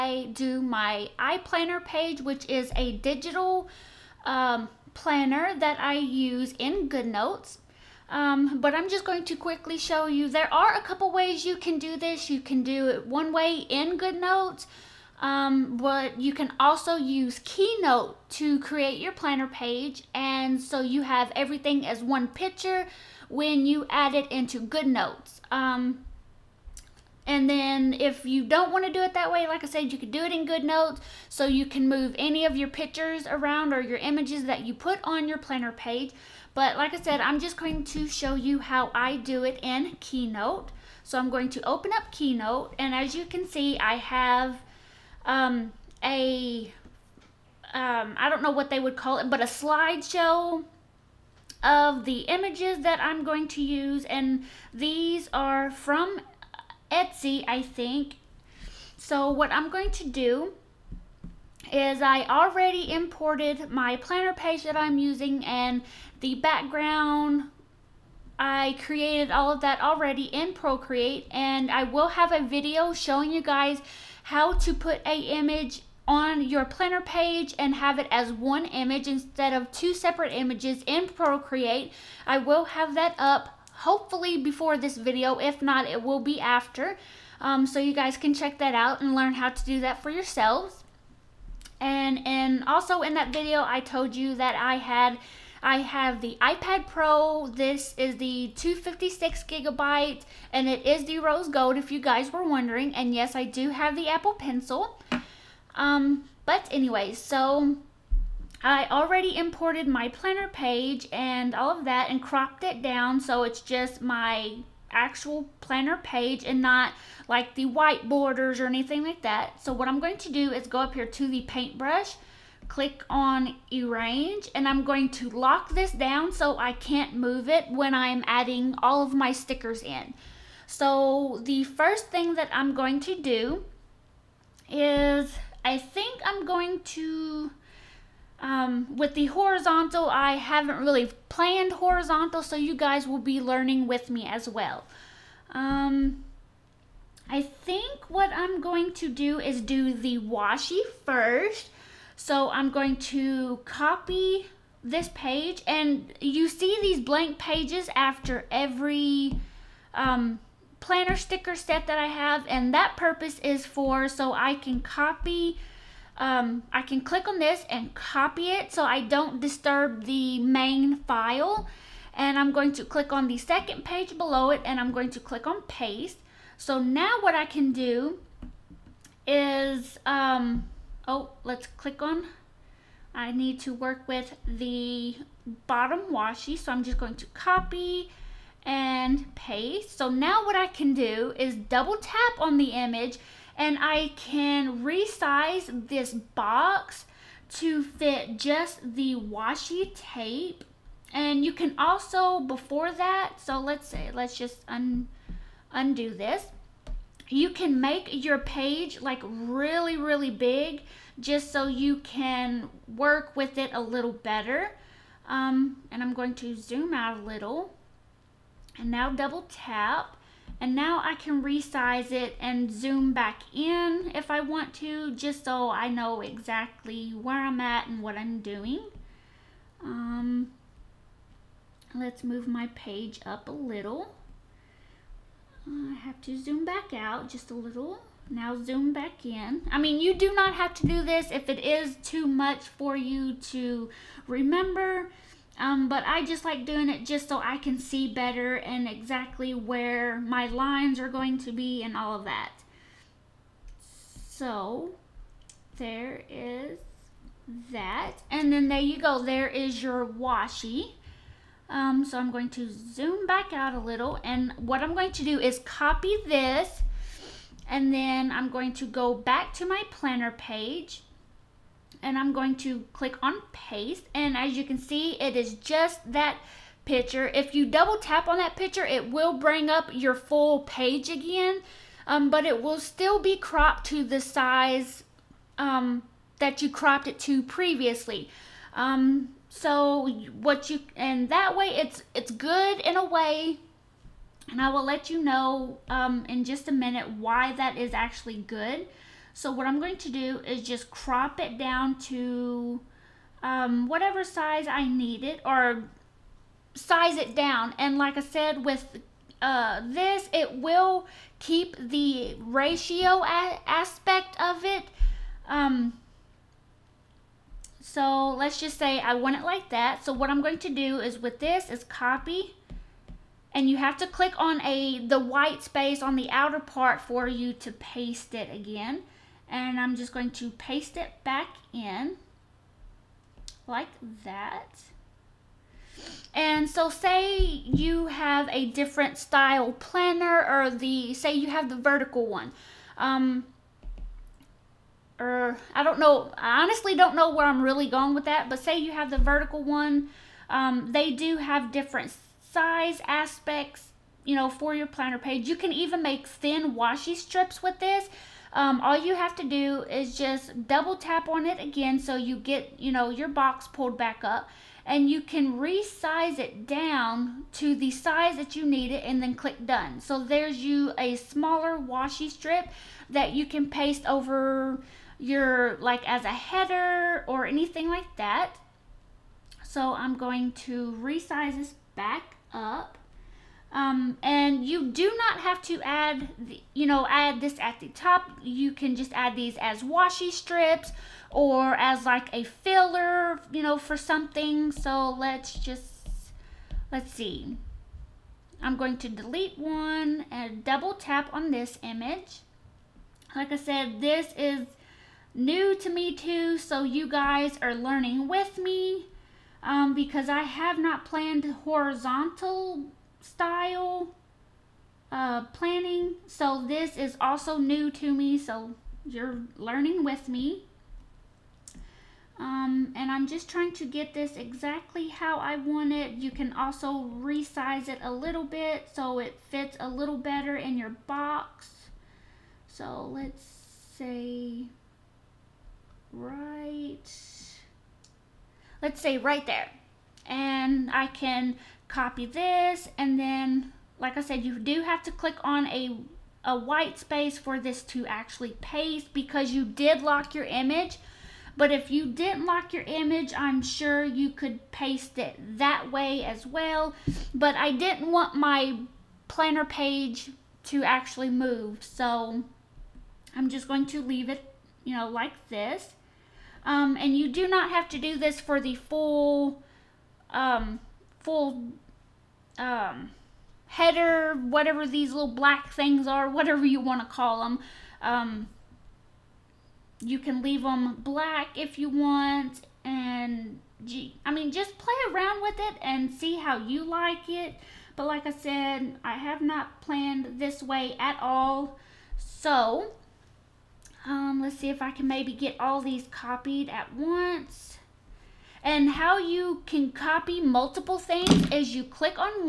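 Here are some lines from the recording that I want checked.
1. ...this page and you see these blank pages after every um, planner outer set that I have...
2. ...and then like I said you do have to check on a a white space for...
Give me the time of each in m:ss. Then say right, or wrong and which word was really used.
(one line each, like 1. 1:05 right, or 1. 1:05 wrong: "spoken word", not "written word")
1. 2:34 wrong: "sticker", not "outer"
2. 7:22 wrong: "click", not "check".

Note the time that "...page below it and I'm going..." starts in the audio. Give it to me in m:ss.
2:53.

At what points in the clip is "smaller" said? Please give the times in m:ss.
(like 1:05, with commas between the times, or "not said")
6:11.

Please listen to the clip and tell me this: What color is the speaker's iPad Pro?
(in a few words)
rose gold.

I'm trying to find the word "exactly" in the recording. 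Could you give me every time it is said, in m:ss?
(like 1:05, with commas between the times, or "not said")
3:46, 4:08, 7:04.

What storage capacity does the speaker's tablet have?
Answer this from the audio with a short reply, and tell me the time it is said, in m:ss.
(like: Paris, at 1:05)
256 gigabytes, at 1:38.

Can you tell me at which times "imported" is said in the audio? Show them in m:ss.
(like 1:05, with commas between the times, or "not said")
1:02, 1:49.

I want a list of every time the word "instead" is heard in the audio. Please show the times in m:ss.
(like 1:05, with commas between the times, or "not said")
1:19.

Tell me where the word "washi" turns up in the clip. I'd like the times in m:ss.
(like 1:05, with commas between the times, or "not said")
2:30, 3:06, 3:19, 4:20, 5:56, 6:11, 6:29.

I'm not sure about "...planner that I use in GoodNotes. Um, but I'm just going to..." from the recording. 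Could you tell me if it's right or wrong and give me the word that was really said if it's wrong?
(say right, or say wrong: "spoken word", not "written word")
right.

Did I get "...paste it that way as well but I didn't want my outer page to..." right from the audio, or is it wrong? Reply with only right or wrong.
wrong.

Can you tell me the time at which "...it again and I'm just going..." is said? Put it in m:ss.
5:28.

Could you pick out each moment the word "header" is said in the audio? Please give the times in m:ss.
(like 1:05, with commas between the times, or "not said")
6:16, 7:53.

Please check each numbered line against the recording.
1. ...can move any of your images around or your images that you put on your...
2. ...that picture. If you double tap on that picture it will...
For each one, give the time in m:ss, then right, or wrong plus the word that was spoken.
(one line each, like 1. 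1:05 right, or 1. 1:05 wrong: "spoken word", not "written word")
1. 0:31 wrong: "pictures", not "images"
2. 4:36 right.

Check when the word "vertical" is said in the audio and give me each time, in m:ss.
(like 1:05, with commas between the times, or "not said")
5:41, 5:49.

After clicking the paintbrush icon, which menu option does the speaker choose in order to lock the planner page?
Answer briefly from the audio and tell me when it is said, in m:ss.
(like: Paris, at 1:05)
arrange, at 2:03.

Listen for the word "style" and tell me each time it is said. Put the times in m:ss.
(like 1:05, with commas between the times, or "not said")
5:39, 6:53.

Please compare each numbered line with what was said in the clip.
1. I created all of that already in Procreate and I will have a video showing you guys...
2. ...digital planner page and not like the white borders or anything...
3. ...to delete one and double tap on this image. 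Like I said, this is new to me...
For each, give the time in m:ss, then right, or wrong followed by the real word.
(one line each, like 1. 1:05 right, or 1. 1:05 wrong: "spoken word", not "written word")
1. 1:08 right
2. 1:54 wrong: "actual", not "digital"
3. 6:38 right.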